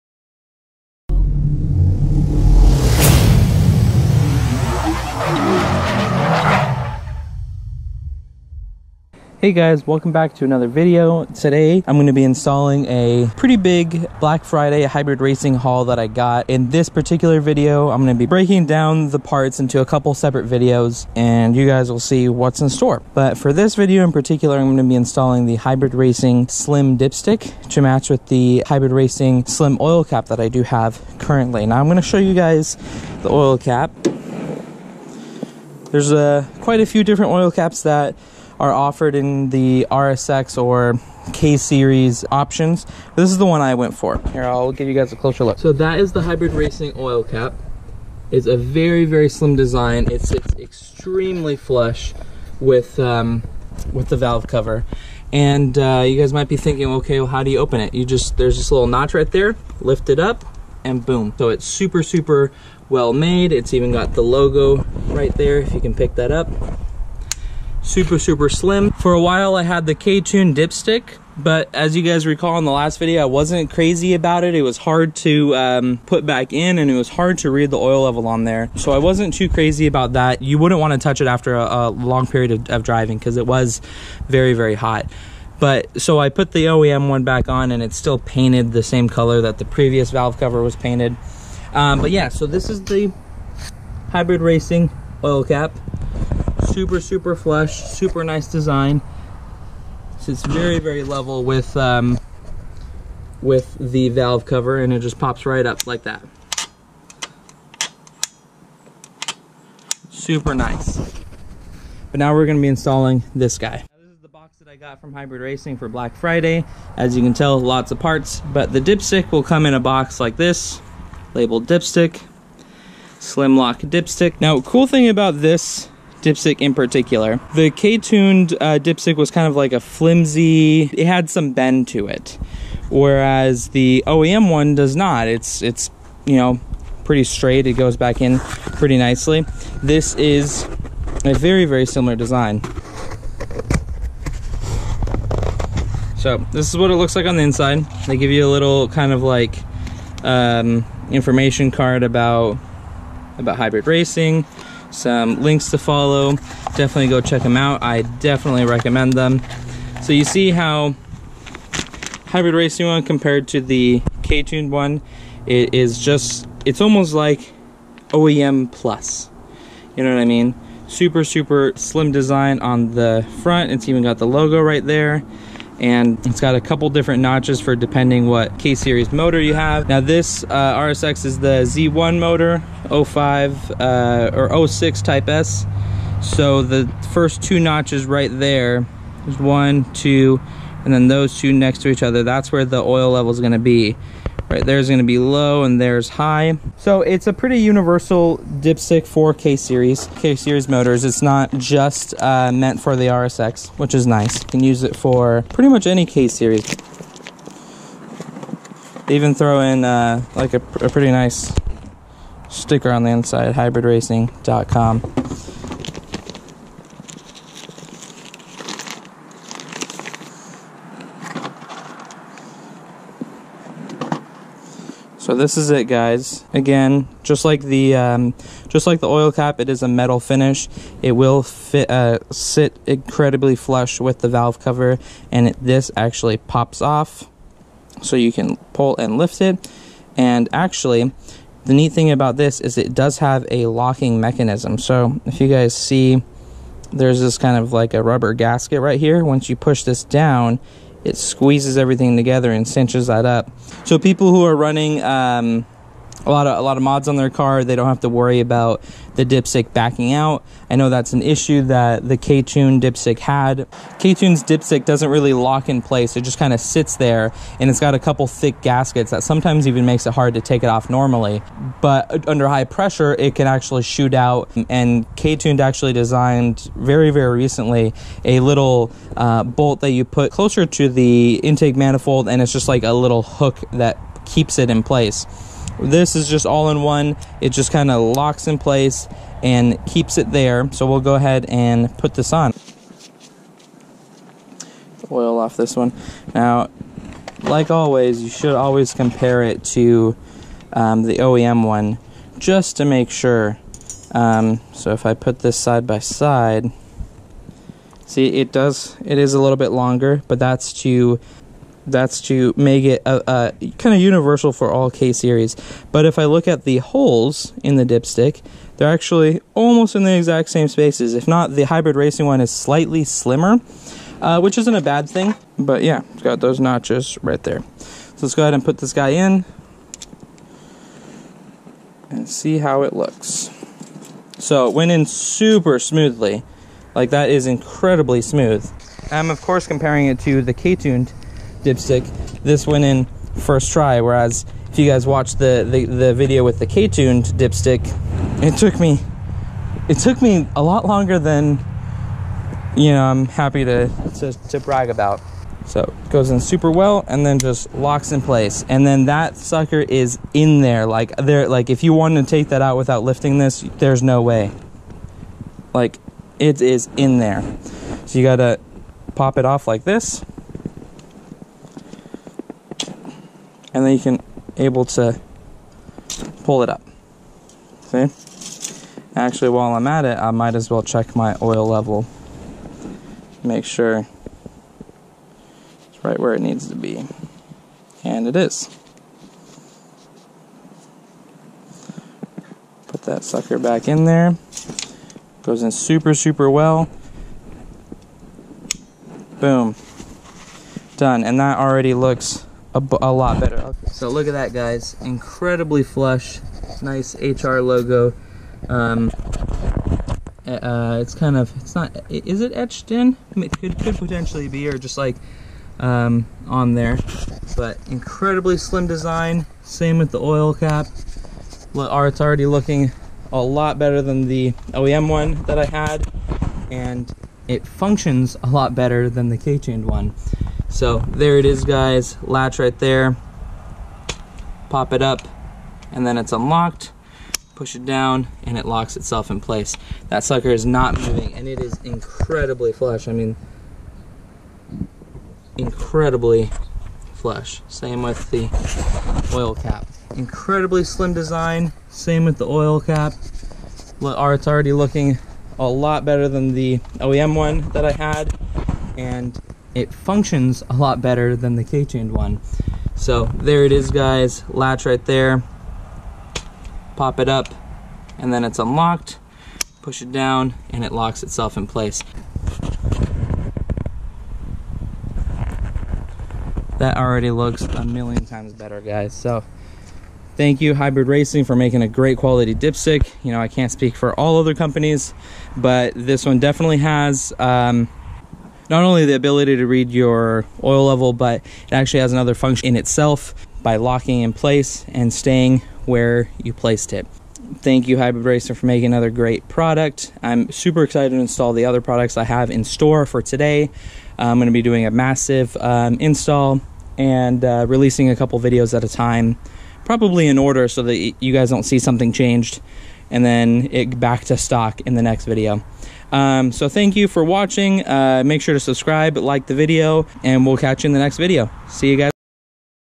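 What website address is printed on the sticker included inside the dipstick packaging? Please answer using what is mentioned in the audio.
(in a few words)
hybridracing.com.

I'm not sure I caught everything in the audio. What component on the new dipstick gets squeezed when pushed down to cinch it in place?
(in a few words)
rubber gasket.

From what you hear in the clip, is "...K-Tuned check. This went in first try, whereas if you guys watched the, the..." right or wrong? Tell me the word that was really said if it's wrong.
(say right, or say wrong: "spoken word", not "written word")
wrong: "dipstick", not "check".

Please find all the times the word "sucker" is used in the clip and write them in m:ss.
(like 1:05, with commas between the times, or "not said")
5:59, 6:33, 7:20.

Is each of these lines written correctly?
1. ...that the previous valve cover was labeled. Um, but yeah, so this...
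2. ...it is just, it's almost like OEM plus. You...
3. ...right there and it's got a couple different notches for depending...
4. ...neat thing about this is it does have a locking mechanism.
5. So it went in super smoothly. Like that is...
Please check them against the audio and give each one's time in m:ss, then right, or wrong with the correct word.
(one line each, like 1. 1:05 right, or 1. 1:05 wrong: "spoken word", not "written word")
1. 1:29 wrong: "painted", not "labeled"
2. 2:45 right
3. 2:54 right
4. 4:01 right
5. 5:34 right.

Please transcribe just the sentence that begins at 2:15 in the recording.
It's, it's you know, pretty straight.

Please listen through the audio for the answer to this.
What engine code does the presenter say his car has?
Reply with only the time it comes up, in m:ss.
3:01.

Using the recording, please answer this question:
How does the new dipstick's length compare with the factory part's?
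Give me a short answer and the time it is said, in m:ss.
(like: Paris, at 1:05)
a little bit longer, at 5:09.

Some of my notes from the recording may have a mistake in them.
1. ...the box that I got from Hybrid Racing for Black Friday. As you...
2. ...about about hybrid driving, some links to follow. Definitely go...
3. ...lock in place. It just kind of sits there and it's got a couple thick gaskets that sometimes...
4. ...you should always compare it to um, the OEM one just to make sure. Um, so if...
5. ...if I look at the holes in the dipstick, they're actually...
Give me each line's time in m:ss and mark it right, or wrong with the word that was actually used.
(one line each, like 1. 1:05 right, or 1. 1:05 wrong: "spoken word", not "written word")
1. 1:54 right
2. 2:32 wrong: "racing", not "driving"
3. 4:25 right
4. 4:58 right
5. 5:16 right.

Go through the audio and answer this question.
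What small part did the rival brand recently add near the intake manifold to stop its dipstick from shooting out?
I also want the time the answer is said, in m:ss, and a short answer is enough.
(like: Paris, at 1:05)
bolt, at 4:39.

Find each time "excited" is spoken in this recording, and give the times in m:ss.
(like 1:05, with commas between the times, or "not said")
8:20.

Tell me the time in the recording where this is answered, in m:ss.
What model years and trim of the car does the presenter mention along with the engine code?
3:02.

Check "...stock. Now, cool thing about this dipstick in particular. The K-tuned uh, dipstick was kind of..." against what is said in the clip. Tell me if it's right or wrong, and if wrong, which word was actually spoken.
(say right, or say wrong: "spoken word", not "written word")
wrong: "dipstick", not "stock".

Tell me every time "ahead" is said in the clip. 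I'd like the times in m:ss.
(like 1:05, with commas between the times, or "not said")
4:51, 5:28.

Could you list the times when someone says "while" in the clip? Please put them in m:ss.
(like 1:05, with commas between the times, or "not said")
1:09, 6:19.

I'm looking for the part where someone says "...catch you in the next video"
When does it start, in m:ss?
8:40.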